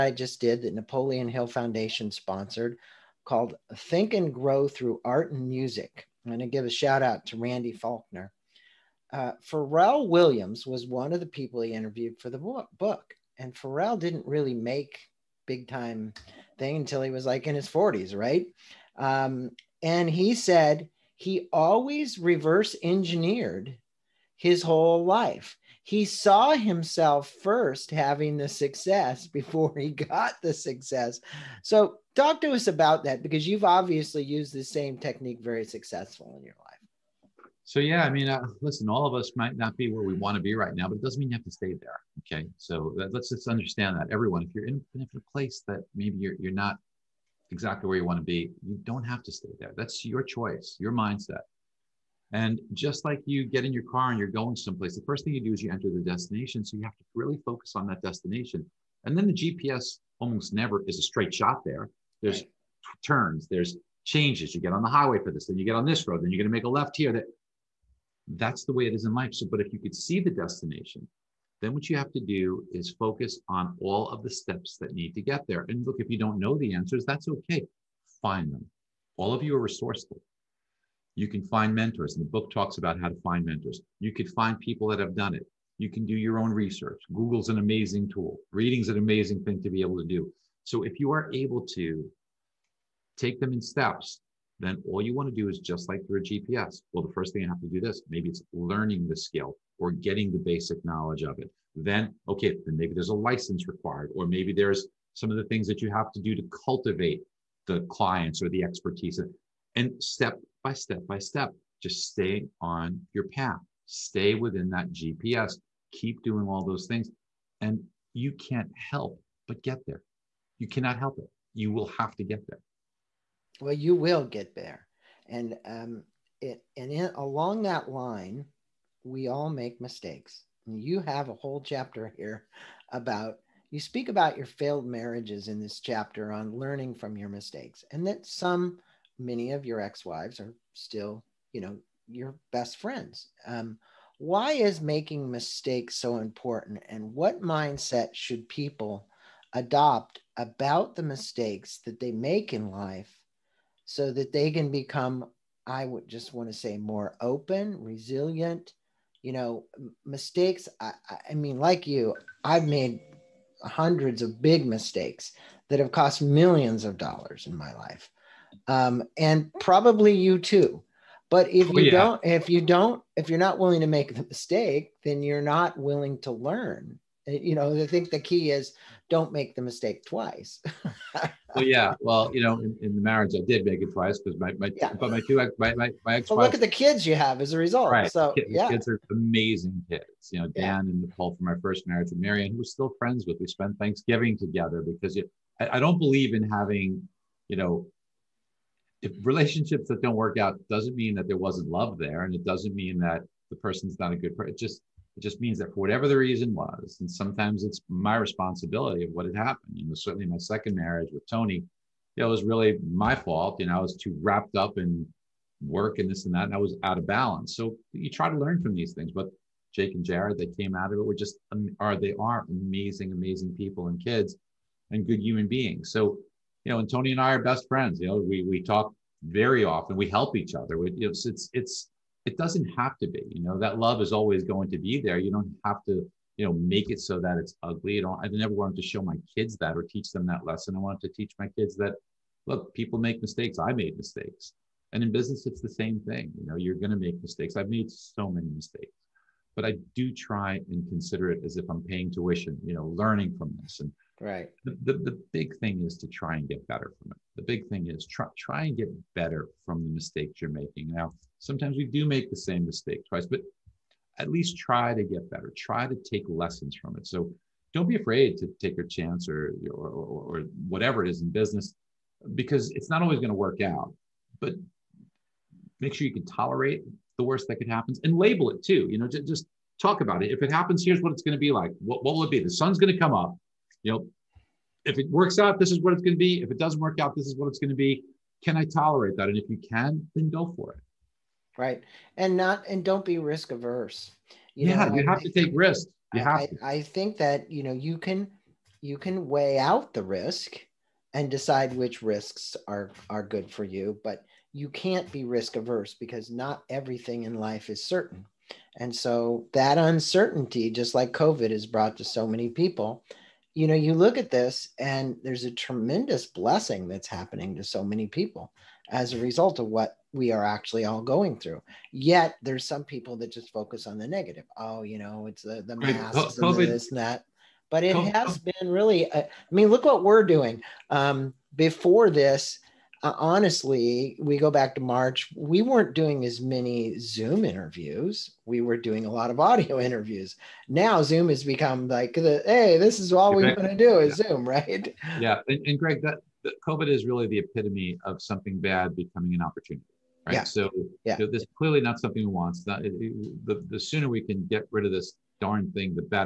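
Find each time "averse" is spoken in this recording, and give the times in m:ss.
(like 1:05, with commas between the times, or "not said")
4:53, 5:05.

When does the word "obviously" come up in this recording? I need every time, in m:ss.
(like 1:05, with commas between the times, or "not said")
0:33.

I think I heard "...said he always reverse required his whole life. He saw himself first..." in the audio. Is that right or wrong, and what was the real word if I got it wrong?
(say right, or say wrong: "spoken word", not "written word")
wrong: "engineered", not "required".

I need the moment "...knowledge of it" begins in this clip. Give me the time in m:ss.
1:40.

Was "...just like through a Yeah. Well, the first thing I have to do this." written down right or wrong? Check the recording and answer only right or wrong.
wrong.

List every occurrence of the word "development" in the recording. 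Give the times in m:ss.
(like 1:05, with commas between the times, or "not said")
not said.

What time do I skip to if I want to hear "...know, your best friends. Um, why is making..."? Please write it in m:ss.
2:21.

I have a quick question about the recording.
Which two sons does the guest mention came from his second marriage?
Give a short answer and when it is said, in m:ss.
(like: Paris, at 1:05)
Jake and Jared, at 3:39.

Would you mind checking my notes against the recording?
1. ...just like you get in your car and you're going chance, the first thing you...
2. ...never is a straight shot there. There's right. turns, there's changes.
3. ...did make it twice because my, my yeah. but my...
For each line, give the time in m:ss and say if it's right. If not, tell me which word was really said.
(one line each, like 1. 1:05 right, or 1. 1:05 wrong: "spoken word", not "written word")
1. 0:52 wrong: "someplace", not "chance"
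2. 1:00 right
3. 3:03 right.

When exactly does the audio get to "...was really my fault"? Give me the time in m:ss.
3:32.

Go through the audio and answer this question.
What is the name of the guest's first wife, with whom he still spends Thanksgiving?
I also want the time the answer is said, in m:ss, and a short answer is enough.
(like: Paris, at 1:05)
Marion, at 3:12.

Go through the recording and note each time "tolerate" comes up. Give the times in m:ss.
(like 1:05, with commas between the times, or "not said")
4:36, 4:48.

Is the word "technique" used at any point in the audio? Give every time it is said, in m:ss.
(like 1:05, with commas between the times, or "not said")
0:34.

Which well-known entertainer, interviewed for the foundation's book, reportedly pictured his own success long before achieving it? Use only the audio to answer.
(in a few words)
Pharrell Williams.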